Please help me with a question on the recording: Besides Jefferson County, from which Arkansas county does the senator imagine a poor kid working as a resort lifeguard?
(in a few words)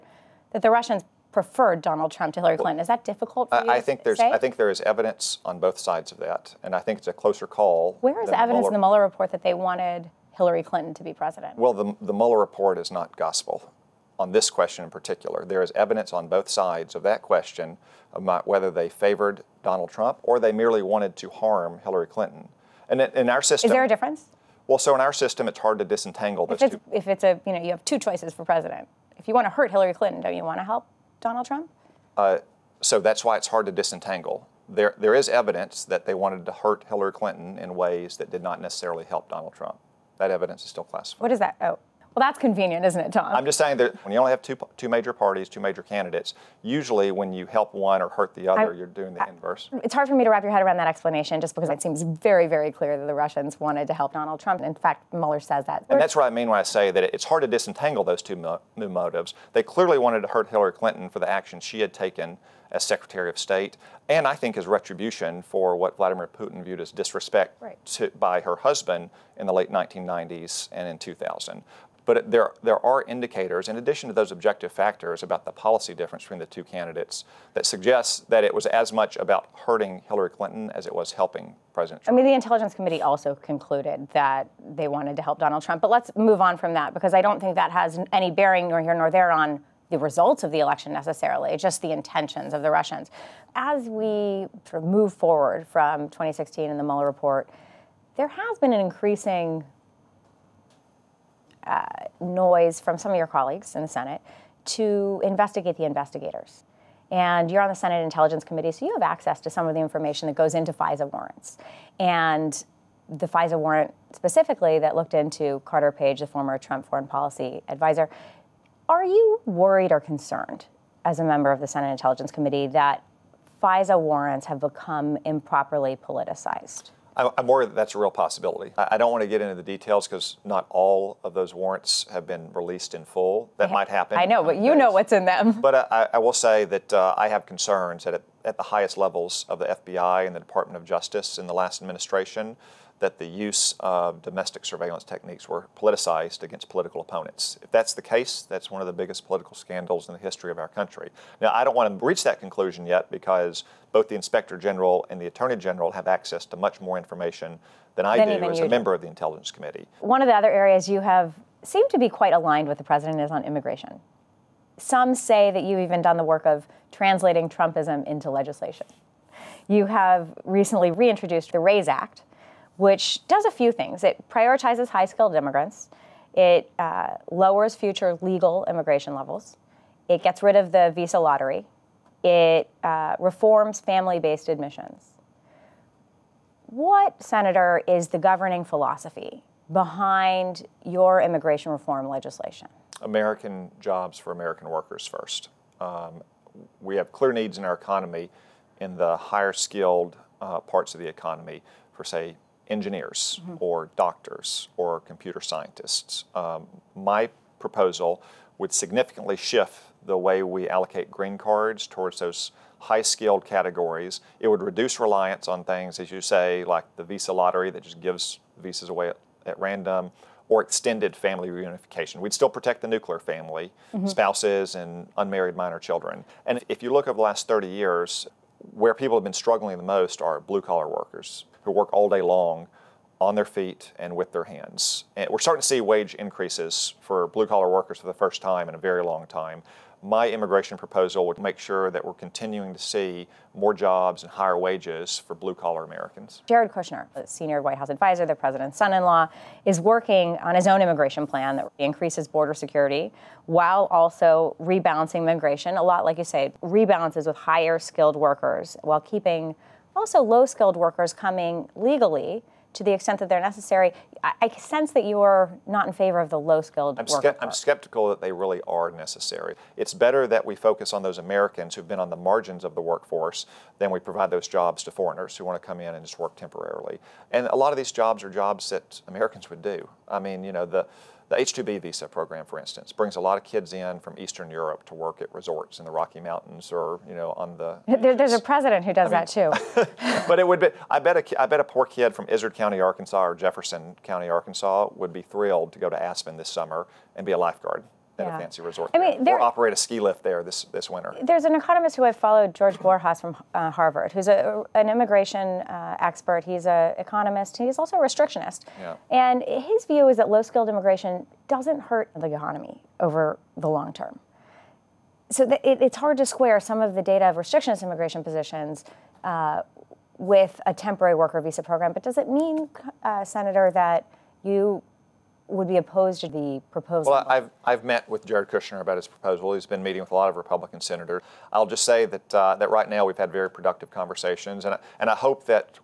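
Izard County.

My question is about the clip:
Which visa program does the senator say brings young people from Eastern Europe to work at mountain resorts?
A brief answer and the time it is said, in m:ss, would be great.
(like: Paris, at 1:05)
H-2B, at 4:41.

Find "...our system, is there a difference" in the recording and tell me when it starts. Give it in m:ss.
0:23.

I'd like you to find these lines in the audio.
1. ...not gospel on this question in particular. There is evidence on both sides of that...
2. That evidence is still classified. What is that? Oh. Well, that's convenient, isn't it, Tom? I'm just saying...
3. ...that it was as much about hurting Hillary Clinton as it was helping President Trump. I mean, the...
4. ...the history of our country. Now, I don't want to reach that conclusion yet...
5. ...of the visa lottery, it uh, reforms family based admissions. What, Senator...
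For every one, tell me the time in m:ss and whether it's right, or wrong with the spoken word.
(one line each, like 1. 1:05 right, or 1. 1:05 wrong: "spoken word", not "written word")
1. 0:12 right
2. 0:40 right
3. 1:18 right
4. 2:30 right
5. 3:00 right.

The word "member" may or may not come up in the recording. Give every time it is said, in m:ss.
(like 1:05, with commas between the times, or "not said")
2:01, 2:38.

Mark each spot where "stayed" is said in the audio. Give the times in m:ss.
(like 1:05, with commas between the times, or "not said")
not said.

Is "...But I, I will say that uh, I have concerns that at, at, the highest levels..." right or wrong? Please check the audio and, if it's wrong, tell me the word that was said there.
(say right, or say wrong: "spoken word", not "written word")
right.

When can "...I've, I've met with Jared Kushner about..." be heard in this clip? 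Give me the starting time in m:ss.
5:27.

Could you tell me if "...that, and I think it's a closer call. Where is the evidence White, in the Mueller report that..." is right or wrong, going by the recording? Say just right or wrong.
wrong.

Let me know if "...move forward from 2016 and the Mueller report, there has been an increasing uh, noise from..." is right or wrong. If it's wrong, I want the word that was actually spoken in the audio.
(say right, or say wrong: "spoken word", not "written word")
right.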